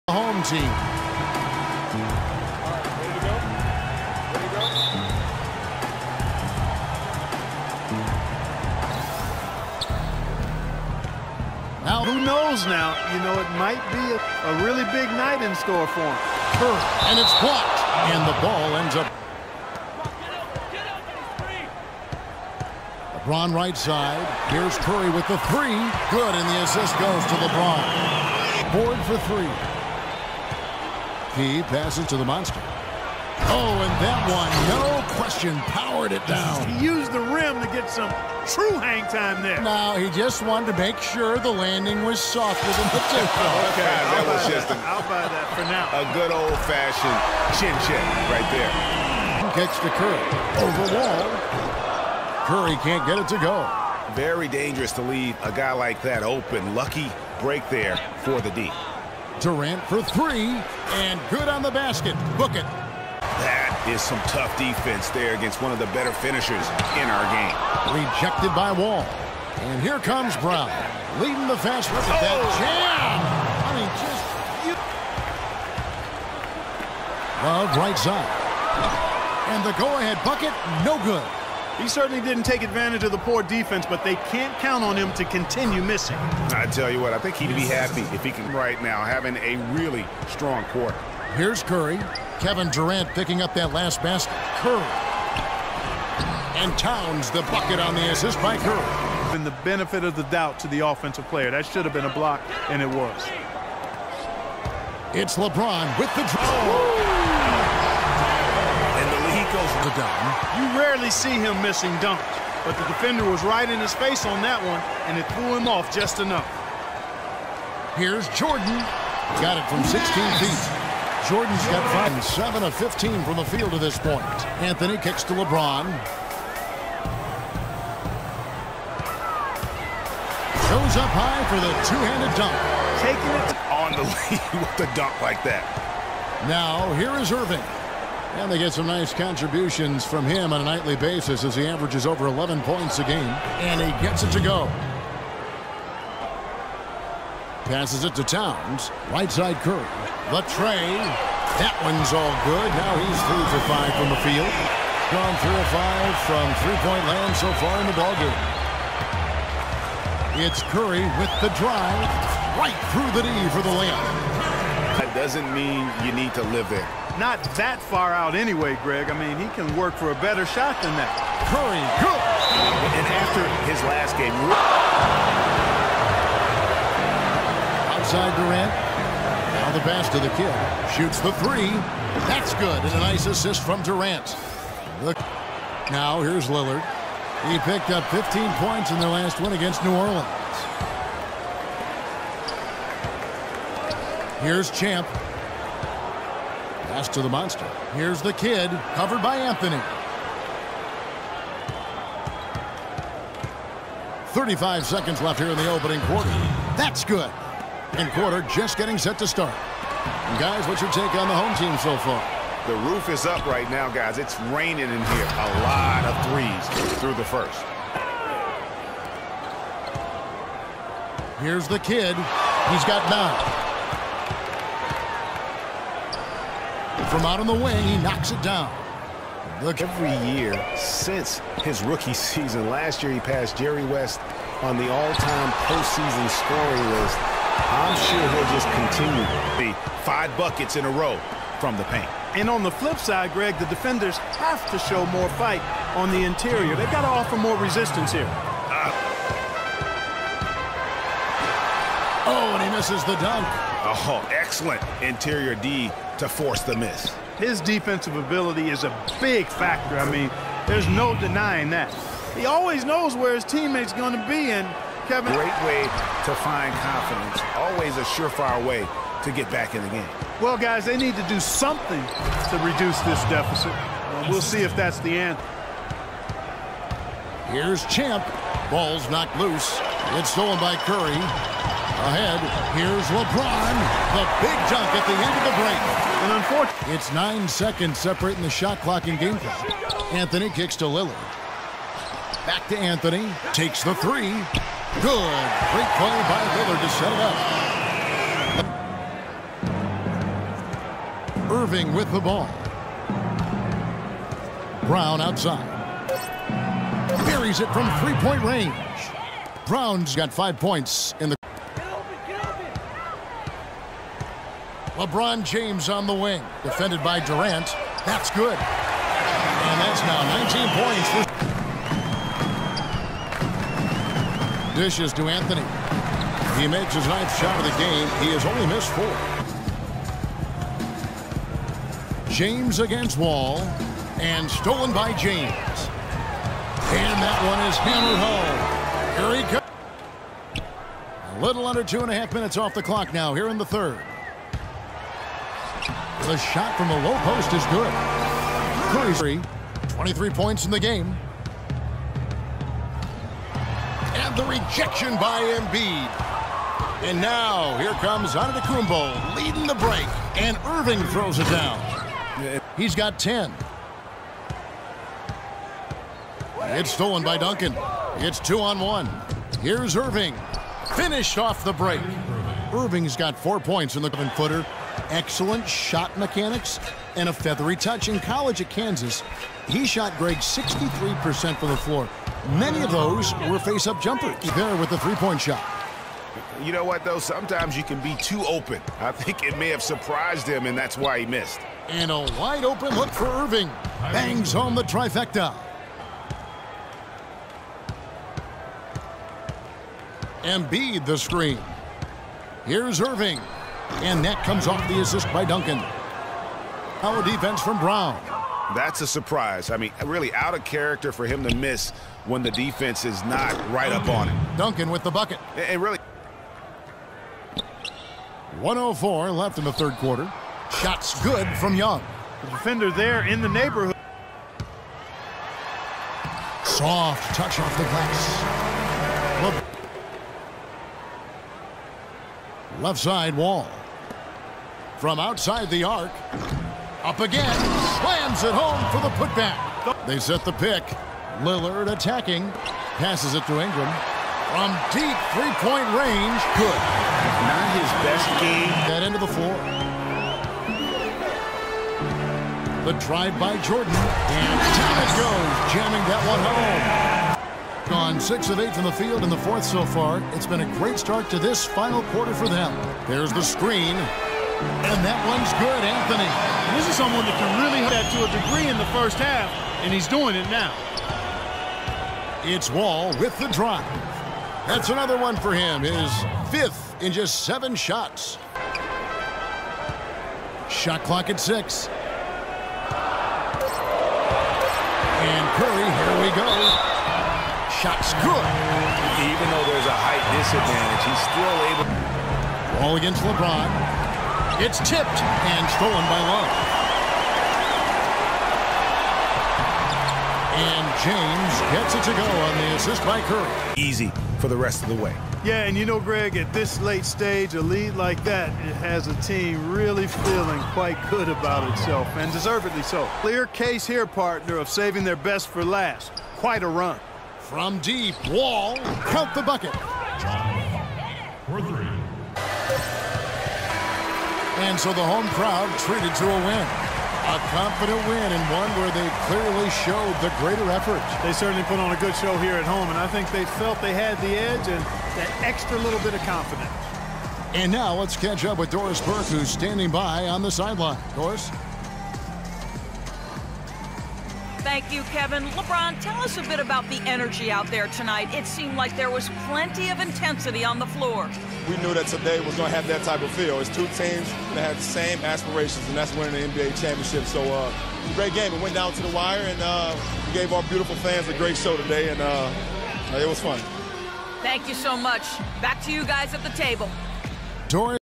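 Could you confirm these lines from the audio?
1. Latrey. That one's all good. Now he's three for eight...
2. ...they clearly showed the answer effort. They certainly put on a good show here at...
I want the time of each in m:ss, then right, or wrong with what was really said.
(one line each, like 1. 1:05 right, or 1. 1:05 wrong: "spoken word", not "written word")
1. 2:30 wrong: "five", not "eight"
2. 8:48 wrong: "greater", not "answer".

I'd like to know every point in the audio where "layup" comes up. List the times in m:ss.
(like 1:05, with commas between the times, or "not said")
2:43.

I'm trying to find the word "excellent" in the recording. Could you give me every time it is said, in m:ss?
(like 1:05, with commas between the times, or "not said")
4:14, 6:15.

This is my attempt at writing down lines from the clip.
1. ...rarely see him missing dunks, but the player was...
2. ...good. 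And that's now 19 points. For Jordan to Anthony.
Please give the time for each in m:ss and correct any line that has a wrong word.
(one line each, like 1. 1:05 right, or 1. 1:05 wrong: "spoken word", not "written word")
1. 1:50 wrong: "defender", not "player"
2. 5:18 wrong: "Dishes", not "Jordan".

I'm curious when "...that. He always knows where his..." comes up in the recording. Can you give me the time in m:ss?
4:21.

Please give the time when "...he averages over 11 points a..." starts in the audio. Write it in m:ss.
2:21.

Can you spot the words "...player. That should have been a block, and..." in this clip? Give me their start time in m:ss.
1:41.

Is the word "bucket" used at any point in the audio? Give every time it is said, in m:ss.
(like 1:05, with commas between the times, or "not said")
1:20, 1:37, 4:00, 6:55, 8:39.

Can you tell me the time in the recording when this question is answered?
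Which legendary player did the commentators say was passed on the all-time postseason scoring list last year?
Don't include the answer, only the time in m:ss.
3:53.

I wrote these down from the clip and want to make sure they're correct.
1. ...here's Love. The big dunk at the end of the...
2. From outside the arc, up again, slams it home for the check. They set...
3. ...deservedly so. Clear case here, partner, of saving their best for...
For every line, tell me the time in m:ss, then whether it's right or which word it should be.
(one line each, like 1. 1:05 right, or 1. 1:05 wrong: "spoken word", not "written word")
1. 4:42 wrong: "LeBron", not "Love"
2. 7:15 wrong: "putback", not "check"
3. 8:32 right.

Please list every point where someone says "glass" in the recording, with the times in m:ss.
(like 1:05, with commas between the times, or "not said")
7:07.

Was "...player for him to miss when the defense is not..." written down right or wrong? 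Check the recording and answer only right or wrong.
wrong.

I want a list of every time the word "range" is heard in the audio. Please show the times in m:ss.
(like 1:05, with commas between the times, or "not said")
5:08, 7:25.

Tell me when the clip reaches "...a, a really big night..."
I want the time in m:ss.
0:14.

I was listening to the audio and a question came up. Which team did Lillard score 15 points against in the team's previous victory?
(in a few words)
New Orleans.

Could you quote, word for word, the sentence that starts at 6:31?
And a wide-open look for Irving.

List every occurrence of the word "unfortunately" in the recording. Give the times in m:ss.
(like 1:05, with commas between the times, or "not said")
4:46.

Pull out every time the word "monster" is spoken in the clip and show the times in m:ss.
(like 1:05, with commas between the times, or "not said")
0:32, 3:17.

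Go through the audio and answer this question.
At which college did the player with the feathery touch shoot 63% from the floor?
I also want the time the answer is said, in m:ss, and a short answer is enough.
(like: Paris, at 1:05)
Kansas, at 6:18.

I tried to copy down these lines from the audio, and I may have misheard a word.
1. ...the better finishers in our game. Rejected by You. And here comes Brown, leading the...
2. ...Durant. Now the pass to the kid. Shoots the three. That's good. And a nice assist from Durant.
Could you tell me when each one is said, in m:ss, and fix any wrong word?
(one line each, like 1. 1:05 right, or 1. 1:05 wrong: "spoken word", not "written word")
1. 1:05 wrong: "Wall", not "You"
2. 2:58 right.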